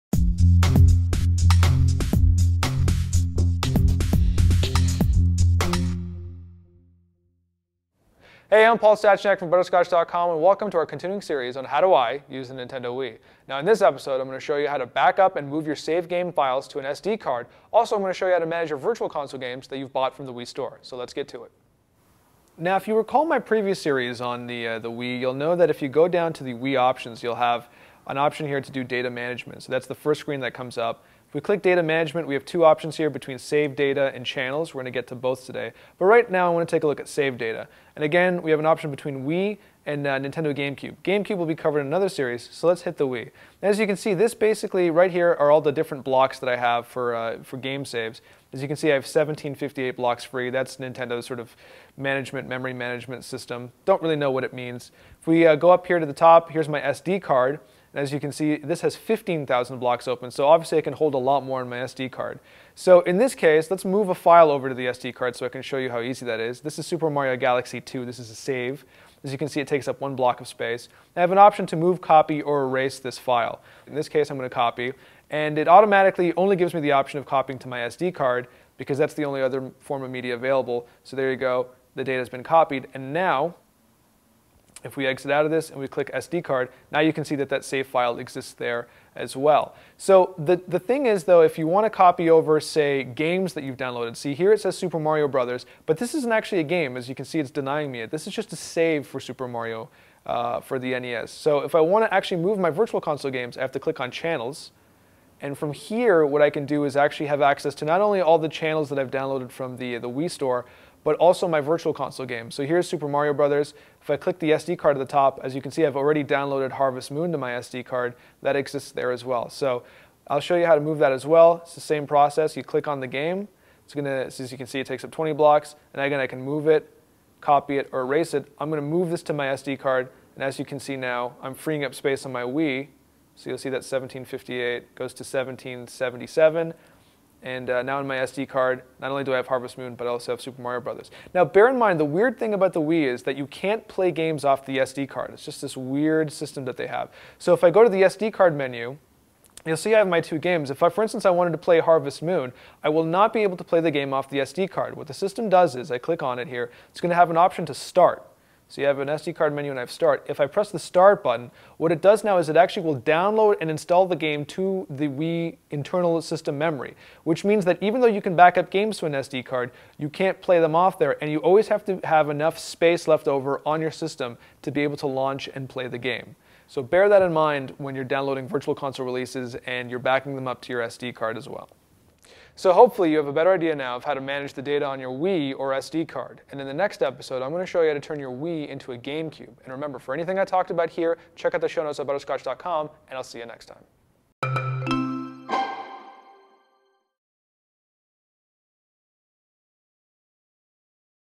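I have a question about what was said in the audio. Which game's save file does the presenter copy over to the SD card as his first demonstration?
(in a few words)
Super Mario Galaxy 2.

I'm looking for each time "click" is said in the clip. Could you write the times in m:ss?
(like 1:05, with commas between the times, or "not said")
0:31, 1:25, 1:43, 1:54, 2:02, 2:35.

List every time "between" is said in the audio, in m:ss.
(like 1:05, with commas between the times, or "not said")
0:33, 0:38.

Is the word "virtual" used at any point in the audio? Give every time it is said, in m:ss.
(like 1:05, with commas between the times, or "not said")
0:18, 1:42, 1:51, 2:58.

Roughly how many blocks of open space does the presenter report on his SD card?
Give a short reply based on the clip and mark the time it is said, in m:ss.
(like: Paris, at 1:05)
15,000, at 0:58.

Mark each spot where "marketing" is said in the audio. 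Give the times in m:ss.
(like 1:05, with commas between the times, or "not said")
not said.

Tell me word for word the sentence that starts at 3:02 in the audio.
So hopefully you have a better idea now of how to manage the data on your Wii or SD card.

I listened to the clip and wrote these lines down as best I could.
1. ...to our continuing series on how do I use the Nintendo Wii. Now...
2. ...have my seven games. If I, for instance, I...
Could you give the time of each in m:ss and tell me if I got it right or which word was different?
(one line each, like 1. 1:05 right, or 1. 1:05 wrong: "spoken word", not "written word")
1. 0:10 right
2. 2:29 wrong: "two", not "seven".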